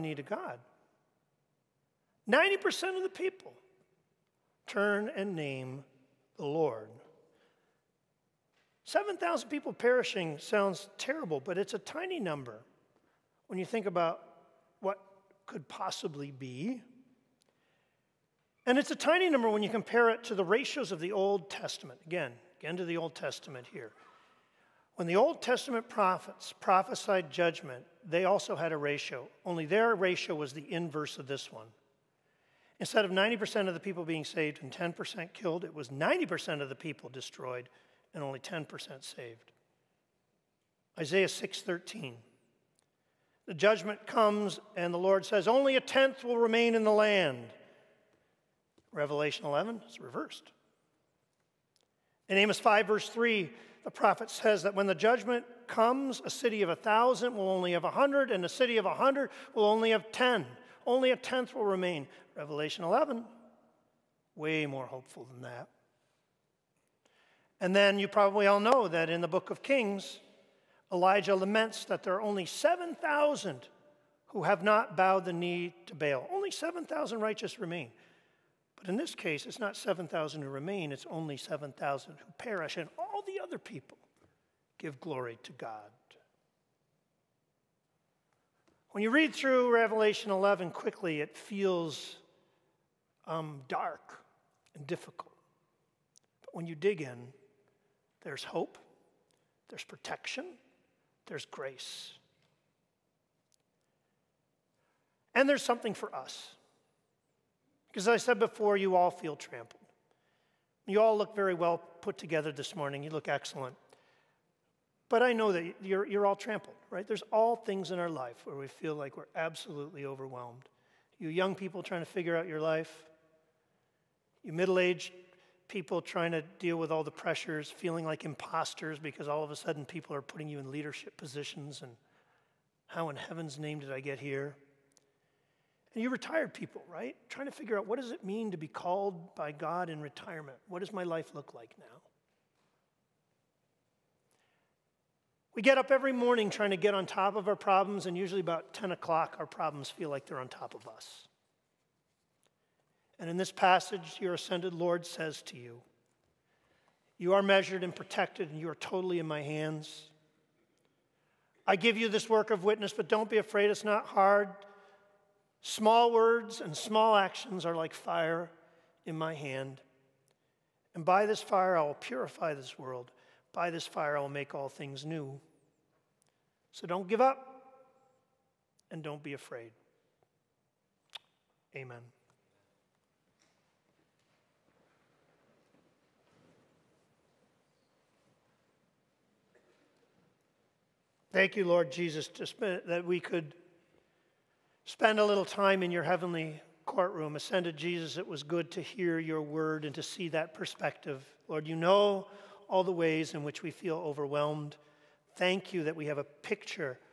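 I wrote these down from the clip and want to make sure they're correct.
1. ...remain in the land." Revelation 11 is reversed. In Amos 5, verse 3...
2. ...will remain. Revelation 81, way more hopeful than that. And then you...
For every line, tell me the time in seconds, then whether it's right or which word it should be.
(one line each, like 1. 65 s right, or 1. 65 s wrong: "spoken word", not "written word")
1. 46 s right
2. 61 s wrong: "11", not "81".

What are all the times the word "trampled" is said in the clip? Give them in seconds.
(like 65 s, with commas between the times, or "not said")
109 s, 116 s.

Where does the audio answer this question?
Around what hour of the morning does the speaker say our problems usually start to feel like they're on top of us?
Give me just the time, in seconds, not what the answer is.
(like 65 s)
148 s.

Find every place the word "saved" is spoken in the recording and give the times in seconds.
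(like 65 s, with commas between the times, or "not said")
34 s, 39 s.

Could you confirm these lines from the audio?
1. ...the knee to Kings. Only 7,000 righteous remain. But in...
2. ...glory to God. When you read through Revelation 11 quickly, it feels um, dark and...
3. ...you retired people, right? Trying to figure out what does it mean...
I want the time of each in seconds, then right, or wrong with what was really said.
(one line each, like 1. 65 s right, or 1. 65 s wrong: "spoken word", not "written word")
1. 75 s wrong: "Baal", not "Kings"
2. 84 s right
3. 136 s right.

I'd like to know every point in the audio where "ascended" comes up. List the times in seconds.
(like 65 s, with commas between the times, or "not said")
154 s, 197 s.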